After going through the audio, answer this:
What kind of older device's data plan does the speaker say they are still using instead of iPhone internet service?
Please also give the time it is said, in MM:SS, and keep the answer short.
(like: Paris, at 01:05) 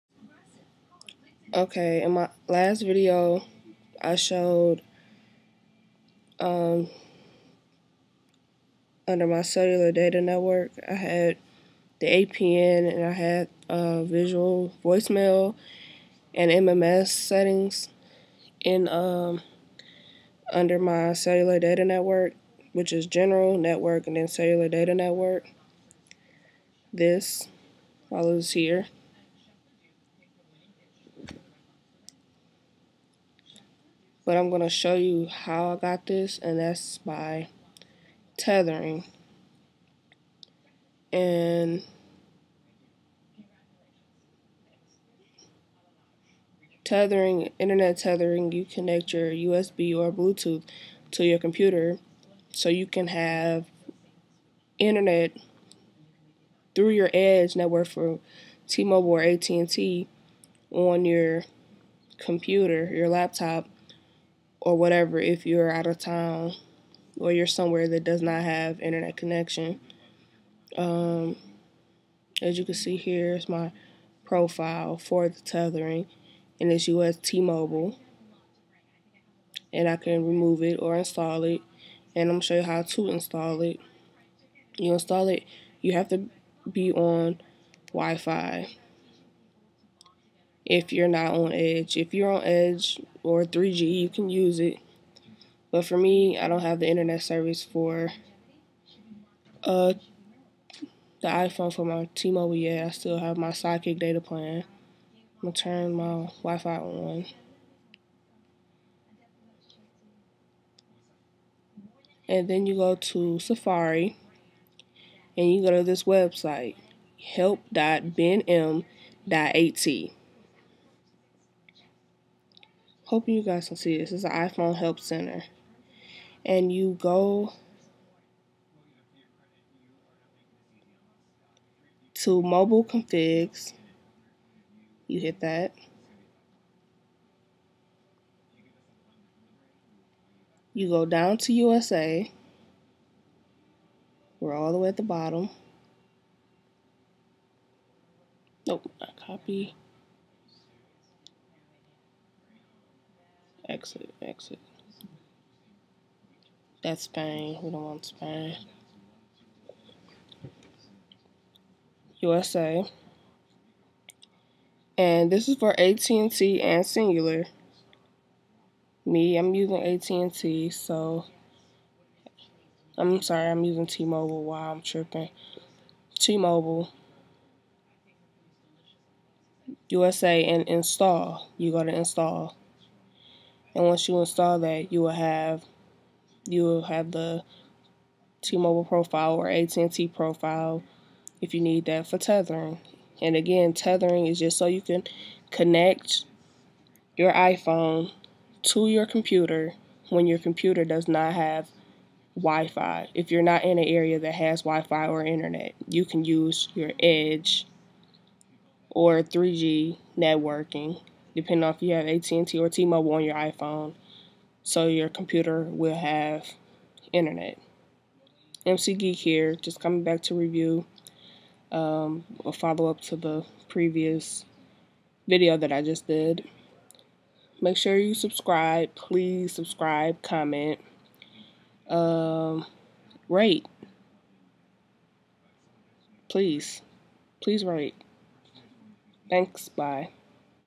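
Sidekick, at 01:43.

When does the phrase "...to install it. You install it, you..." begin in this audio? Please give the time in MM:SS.
01:22.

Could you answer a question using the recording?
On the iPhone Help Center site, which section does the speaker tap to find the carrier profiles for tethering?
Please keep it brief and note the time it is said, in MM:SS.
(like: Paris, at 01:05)
mobile configs, at 02:12.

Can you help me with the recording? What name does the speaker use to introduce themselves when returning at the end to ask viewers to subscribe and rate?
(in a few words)
EmceeGeek.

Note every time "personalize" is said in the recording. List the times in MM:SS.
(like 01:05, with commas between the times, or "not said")
not said.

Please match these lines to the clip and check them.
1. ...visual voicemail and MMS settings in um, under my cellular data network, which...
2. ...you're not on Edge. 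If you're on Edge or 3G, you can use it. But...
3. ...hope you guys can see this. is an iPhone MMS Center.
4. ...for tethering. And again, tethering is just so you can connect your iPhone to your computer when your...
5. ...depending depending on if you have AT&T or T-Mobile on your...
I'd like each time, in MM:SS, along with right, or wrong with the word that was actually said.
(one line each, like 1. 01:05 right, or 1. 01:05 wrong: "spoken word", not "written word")
1. 00:14 right
2. 01:30 right
3. 02:03 wrong: "Help", not "MMS"
4. 03:12 right
5. 03:30 wrong: "networking", not "depending".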